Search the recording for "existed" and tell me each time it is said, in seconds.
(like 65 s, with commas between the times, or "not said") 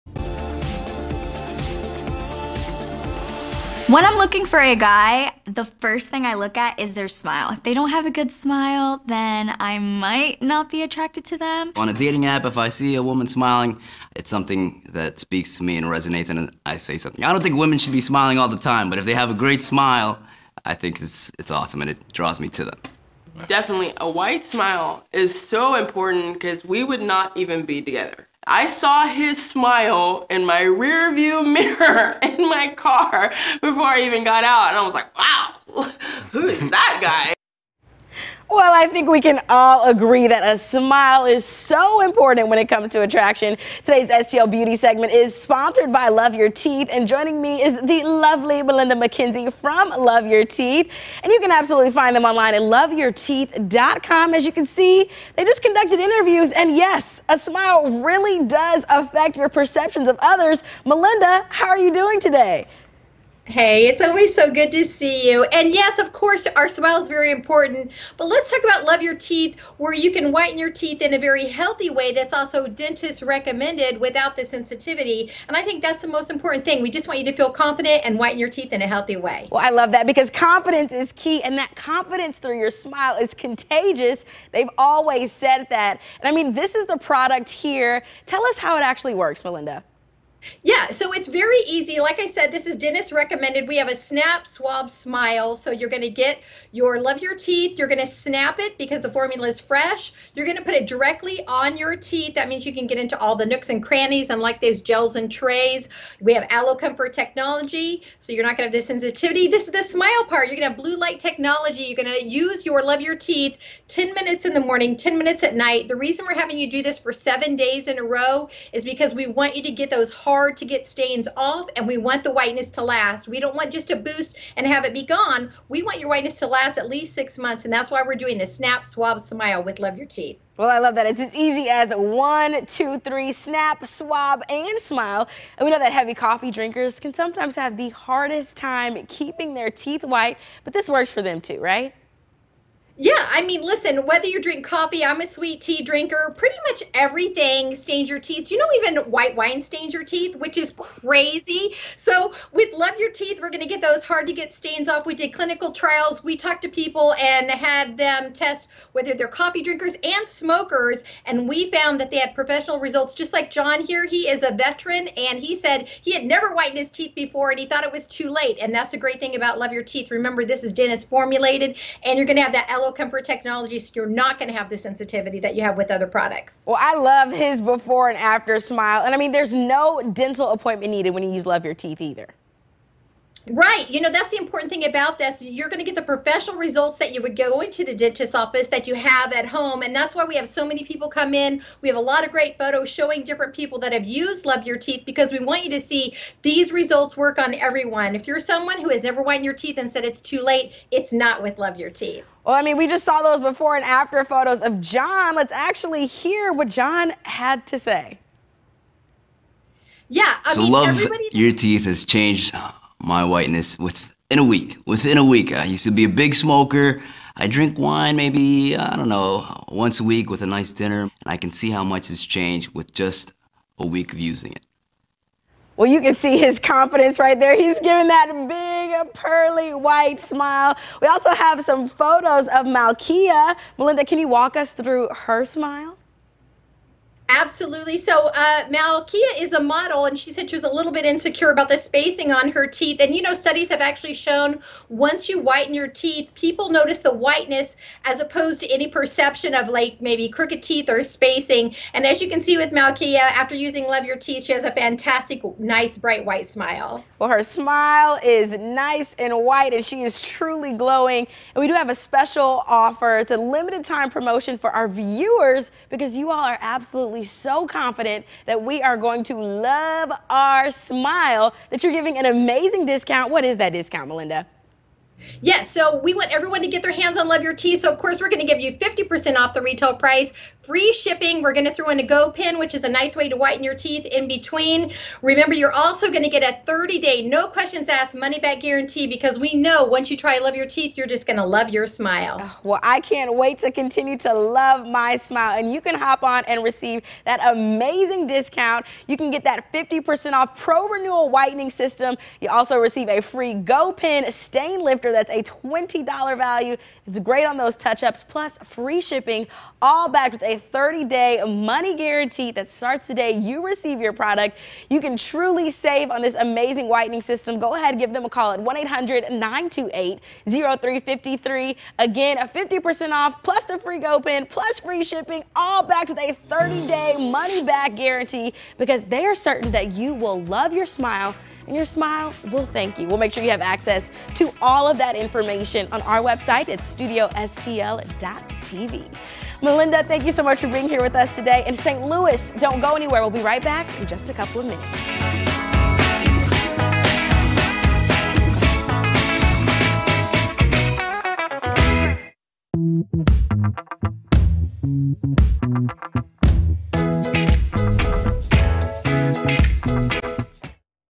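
not said.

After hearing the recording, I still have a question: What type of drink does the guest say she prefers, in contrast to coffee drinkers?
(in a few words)
Sweet tea.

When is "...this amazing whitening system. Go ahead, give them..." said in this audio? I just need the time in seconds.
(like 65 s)
316 s.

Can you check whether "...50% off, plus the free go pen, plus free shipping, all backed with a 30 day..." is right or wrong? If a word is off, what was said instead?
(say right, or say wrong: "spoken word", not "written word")
right.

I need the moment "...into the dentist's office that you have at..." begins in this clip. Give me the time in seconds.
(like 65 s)
187 s.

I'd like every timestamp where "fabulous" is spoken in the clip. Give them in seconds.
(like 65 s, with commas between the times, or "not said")
not said.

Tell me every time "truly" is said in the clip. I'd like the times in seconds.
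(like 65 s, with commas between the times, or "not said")
260 s, 315 s.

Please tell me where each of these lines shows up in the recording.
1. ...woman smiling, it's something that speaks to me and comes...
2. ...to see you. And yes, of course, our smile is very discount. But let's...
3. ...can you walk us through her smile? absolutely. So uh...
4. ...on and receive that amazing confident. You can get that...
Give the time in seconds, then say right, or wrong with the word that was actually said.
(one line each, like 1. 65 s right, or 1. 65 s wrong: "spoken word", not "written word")
1. 13 s wrong: "resonates", not "comes"
2. 64 s wrong: "important", not "discount"
3. 234 s right
4. 296 s wrong: "discount", not "confident".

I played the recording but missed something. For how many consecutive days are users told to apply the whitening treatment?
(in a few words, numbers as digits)
7.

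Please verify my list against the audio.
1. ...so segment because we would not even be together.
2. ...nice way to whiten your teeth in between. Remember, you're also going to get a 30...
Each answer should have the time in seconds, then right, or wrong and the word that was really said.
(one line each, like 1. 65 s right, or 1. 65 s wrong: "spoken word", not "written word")
1. 25 s wrong: "important", not "segment"
2. 282 s right.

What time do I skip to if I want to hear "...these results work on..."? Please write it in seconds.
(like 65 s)
196 s.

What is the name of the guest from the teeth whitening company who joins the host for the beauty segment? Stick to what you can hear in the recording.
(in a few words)
Melinda McKenzie.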